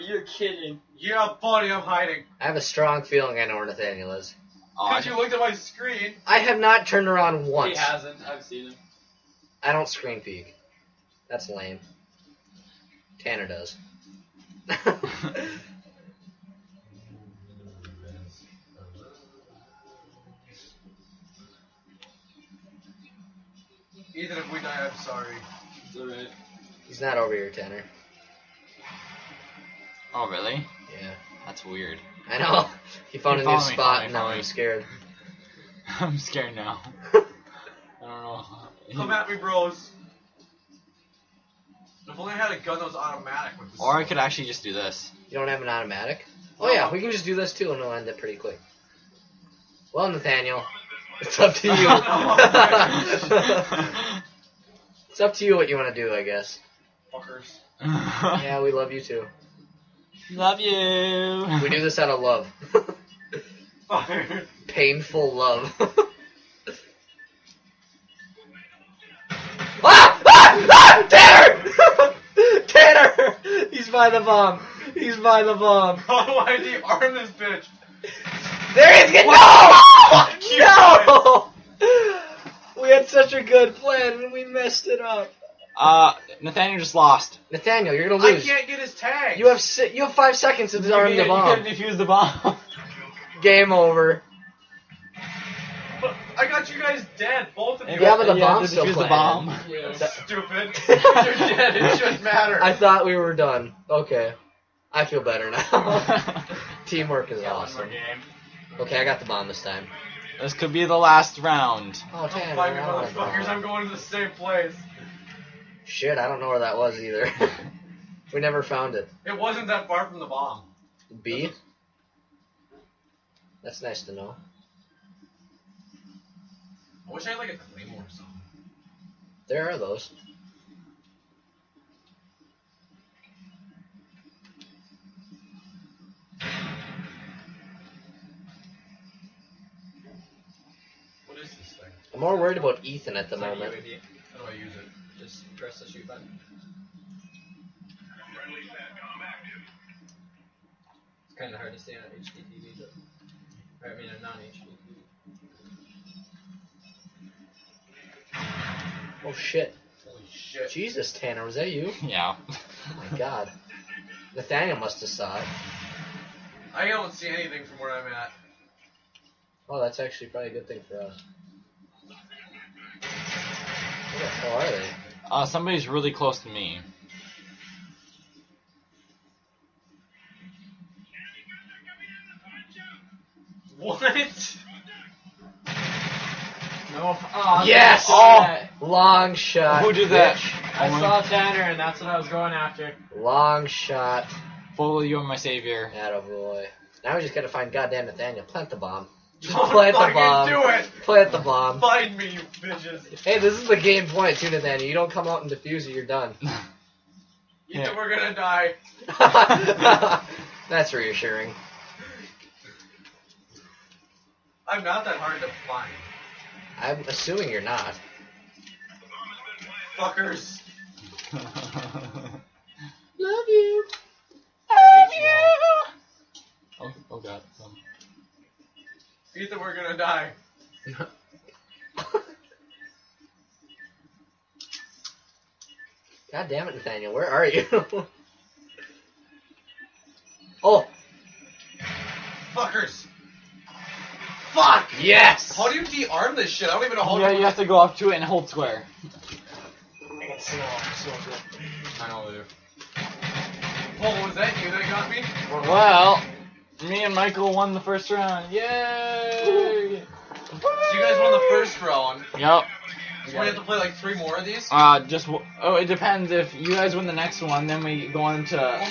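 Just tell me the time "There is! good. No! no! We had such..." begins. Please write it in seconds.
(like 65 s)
78 s.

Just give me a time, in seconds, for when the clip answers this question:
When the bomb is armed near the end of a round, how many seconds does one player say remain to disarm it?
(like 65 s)
90 s.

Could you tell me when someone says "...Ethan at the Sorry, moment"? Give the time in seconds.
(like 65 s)
142 s.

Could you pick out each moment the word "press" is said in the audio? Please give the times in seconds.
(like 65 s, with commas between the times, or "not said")
145 s.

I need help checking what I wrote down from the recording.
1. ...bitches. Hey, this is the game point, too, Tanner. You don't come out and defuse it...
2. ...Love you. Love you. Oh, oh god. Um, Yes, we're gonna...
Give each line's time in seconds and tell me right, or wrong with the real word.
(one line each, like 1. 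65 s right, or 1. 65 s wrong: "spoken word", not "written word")
1. 202 s wrong: "Nathaniel", not "Tanner"
2. 221 s wrong: "Ethan", not "Yes".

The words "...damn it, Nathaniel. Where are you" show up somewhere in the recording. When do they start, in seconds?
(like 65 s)
236 s.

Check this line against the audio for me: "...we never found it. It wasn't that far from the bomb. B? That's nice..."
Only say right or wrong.
right.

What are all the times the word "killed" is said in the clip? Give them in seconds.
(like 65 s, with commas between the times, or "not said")
not said.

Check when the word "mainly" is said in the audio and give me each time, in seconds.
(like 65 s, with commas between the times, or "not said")
not said.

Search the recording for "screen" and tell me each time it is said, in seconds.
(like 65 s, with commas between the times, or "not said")
5 s, 9 s.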